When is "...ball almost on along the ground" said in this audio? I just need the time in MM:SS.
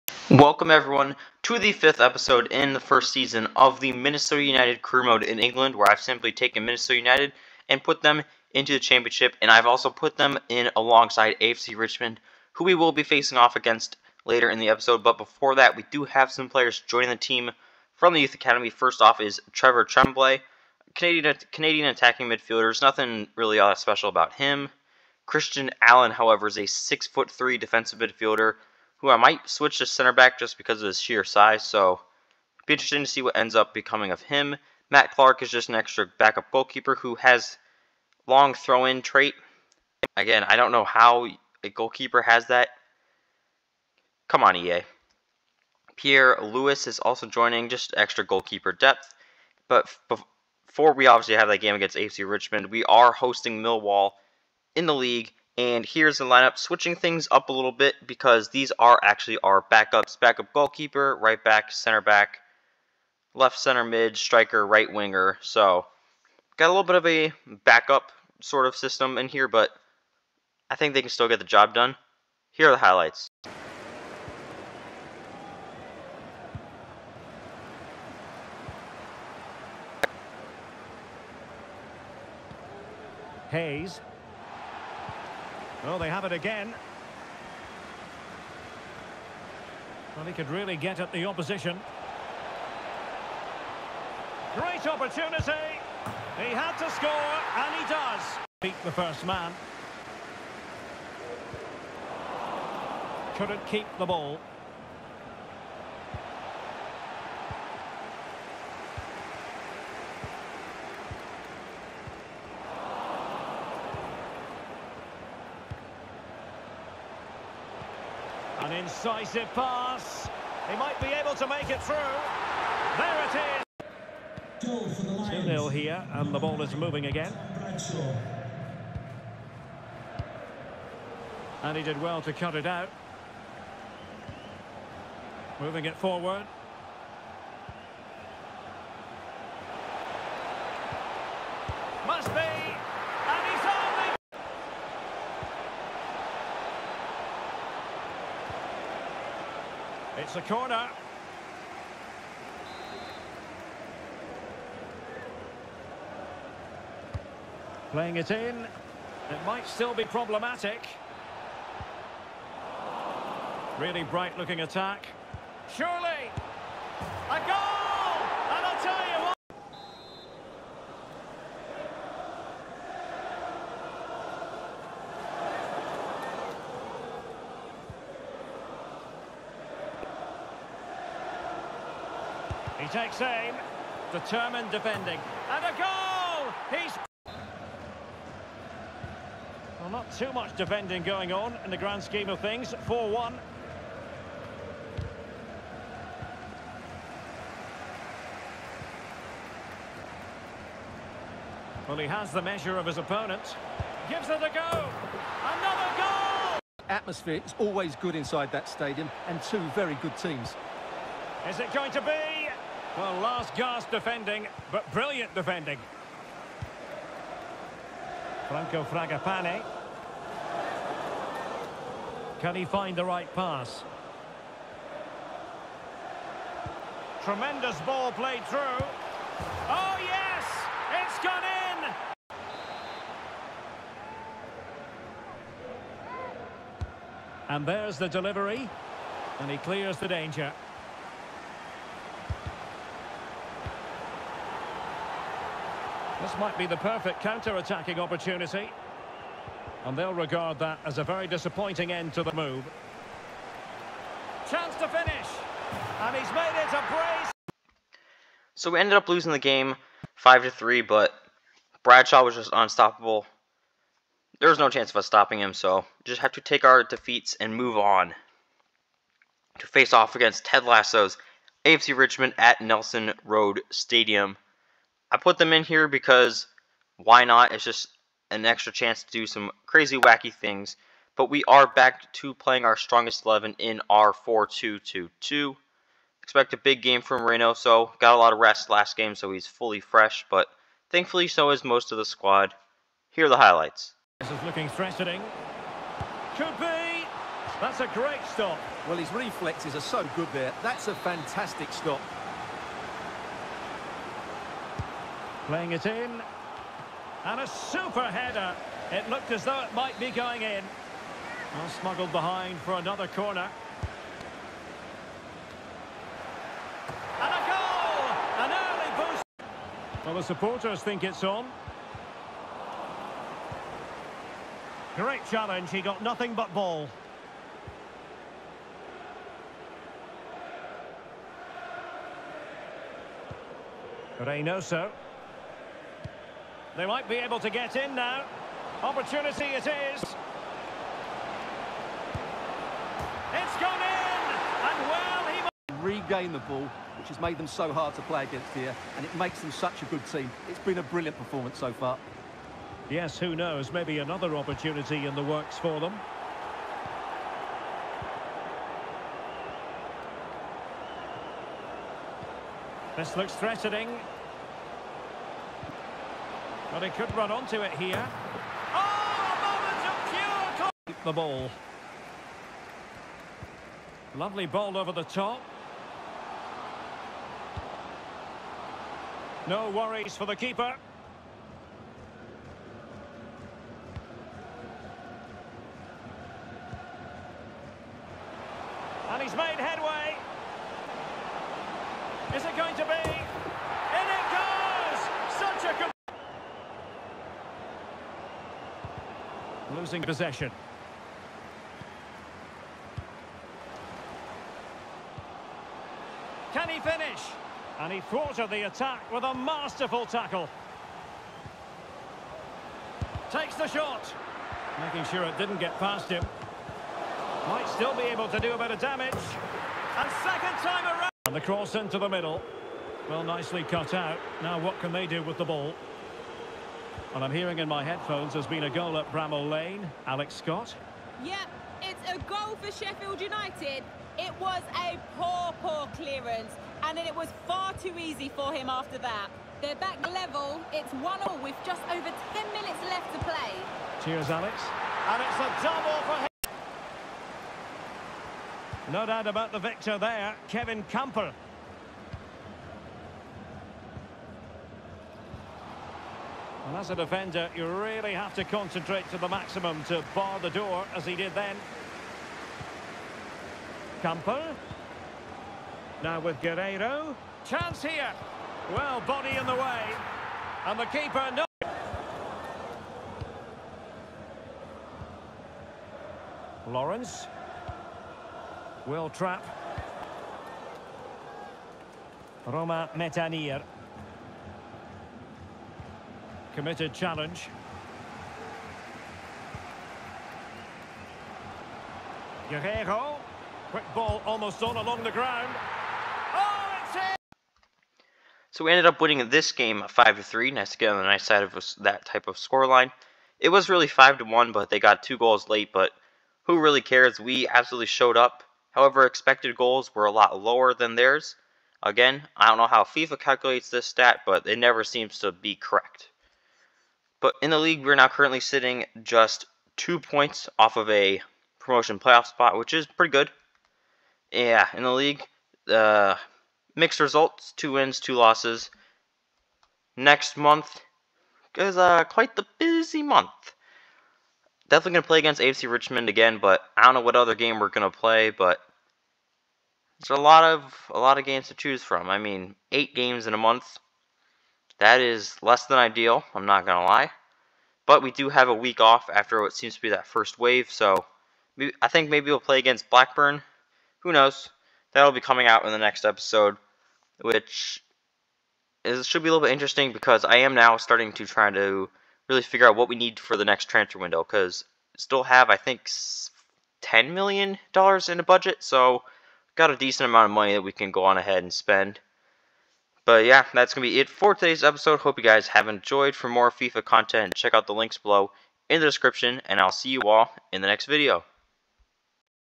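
08:13.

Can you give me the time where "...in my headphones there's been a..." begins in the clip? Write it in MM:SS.
07:07.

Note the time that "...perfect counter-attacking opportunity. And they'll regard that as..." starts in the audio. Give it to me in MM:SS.
04:06.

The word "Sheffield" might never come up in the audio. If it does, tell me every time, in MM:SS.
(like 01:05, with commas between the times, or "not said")
07:12.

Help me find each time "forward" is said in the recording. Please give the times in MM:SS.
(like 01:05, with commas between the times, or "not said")
02:15.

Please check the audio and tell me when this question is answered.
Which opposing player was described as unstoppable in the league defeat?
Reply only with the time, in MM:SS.
04:21.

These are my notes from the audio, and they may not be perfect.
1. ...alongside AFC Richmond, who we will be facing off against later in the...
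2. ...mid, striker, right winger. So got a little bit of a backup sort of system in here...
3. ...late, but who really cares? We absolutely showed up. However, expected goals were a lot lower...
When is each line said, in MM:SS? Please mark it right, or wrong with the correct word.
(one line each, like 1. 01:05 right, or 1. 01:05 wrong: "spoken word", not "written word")
1. 00:10 right
2. 01:03 right
3. 08:25 right.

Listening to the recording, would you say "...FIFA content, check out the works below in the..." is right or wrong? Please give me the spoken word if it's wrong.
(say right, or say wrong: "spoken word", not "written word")
wrong: "links", not "works".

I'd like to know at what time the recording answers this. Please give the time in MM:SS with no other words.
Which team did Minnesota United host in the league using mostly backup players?
00:53.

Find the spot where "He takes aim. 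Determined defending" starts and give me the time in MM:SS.
03:02.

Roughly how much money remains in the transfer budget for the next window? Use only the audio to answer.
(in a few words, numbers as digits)
$10 million.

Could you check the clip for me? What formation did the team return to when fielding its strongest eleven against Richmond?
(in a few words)
4-2-2-2.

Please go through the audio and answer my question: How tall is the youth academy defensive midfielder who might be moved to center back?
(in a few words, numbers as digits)
6'3.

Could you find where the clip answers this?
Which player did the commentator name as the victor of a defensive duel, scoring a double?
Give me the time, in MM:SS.
07:30.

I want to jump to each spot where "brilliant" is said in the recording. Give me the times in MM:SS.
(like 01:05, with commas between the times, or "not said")
03:34, 05:50.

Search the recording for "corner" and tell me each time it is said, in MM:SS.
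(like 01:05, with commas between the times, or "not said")
02:30, 05:13.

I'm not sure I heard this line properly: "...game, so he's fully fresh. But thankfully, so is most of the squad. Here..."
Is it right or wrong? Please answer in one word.
right.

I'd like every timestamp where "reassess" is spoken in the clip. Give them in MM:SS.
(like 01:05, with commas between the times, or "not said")
not said.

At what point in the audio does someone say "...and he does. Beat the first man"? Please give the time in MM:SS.
01:37.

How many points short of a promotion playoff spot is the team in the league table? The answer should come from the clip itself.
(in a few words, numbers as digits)
2.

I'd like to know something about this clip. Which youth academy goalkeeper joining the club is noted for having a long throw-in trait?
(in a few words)
Matt Clark.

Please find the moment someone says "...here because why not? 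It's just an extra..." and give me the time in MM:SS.
04:35.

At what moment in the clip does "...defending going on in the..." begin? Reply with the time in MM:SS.
03:10.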